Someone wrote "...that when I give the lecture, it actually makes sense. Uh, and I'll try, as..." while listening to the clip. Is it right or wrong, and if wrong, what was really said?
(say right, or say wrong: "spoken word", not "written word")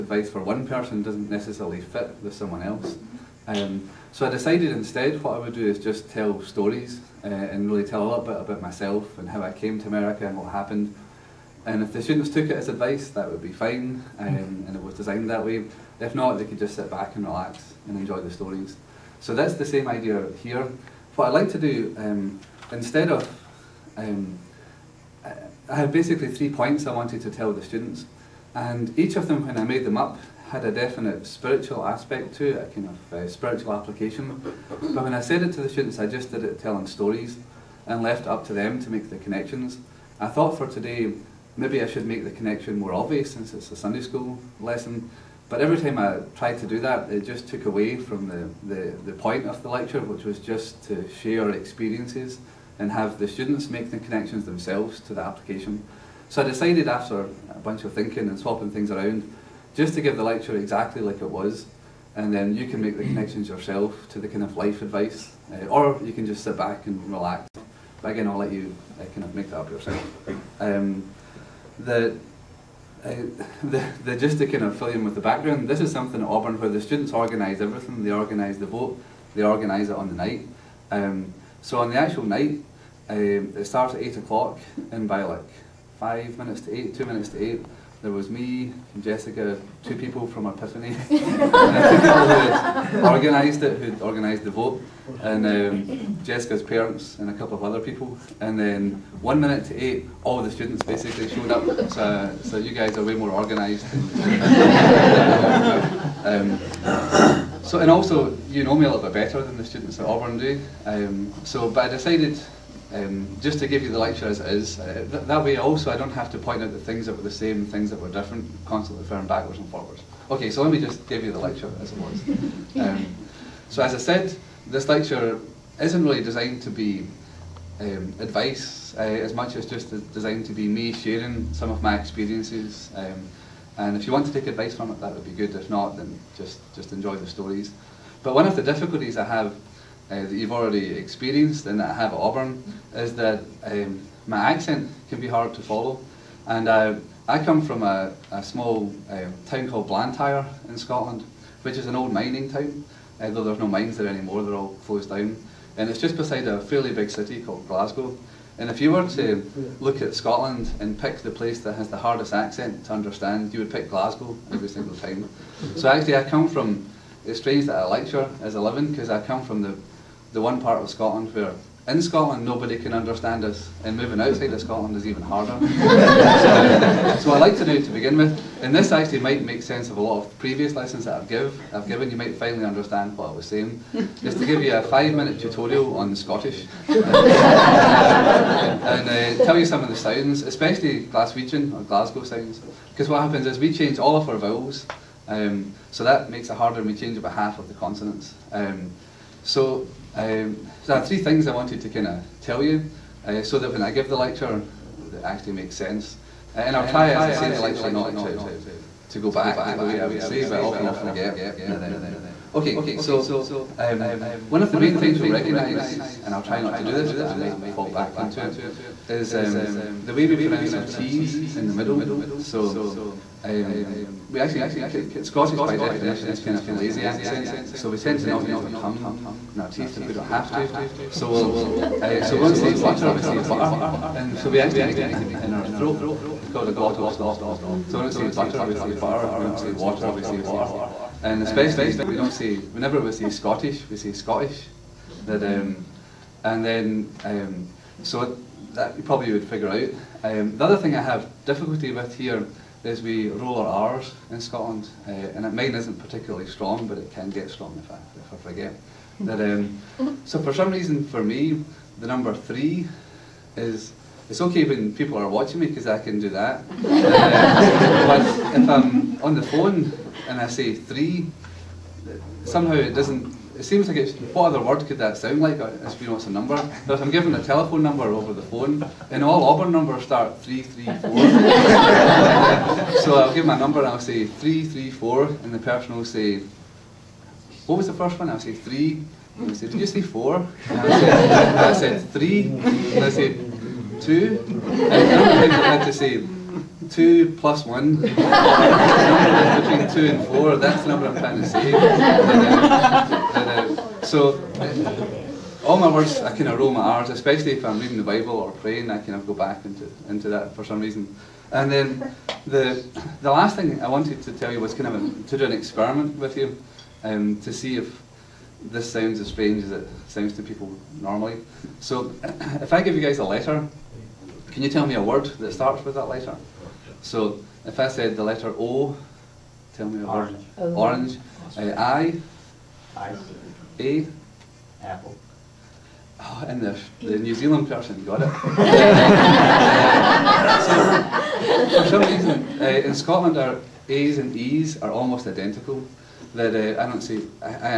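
right.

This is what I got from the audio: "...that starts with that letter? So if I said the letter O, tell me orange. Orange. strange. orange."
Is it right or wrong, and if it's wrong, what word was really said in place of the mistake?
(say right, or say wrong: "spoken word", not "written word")
wrong: "orange", not "strange".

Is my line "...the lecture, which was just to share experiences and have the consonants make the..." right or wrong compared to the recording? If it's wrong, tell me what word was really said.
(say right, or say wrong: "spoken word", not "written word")
wrong: "students", not "consonants".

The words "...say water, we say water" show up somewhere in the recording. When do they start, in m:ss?
3:59.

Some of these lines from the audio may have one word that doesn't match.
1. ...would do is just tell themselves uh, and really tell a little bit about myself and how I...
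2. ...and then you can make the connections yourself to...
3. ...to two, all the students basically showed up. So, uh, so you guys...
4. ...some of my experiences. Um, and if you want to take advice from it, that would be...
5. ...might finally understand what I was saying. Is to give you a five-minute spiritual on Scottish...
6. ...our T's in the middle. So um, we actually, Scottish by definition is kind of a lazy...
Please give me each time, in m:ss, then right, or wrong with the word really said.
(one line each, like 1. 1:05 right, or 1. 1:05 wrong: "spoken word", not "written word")
1. 0:05 wrong: "stories", not "themselves"
2. 1:02 right
3. 1:39 wrong: "eight", not "two"
4. 2:11 right
5. 3:02 wrong: "tutorial", not "spiritual"
6. 3:40 right.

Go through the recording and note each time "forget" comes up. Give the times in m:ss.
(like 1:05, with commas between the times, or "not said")
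3:30, 4:18.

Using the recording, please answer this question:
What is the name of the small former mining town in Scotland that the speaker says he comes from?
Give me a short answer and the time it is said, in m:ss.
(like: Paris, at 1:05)
Blantyre, at 2:29.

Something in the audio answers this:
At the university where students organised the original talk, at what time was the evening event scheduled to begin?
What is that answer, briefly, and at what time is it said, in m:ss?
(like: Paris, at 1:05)
8 o'clock, at 1:24.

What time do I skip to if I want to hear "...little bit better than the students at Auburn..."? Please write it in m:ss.
1:48.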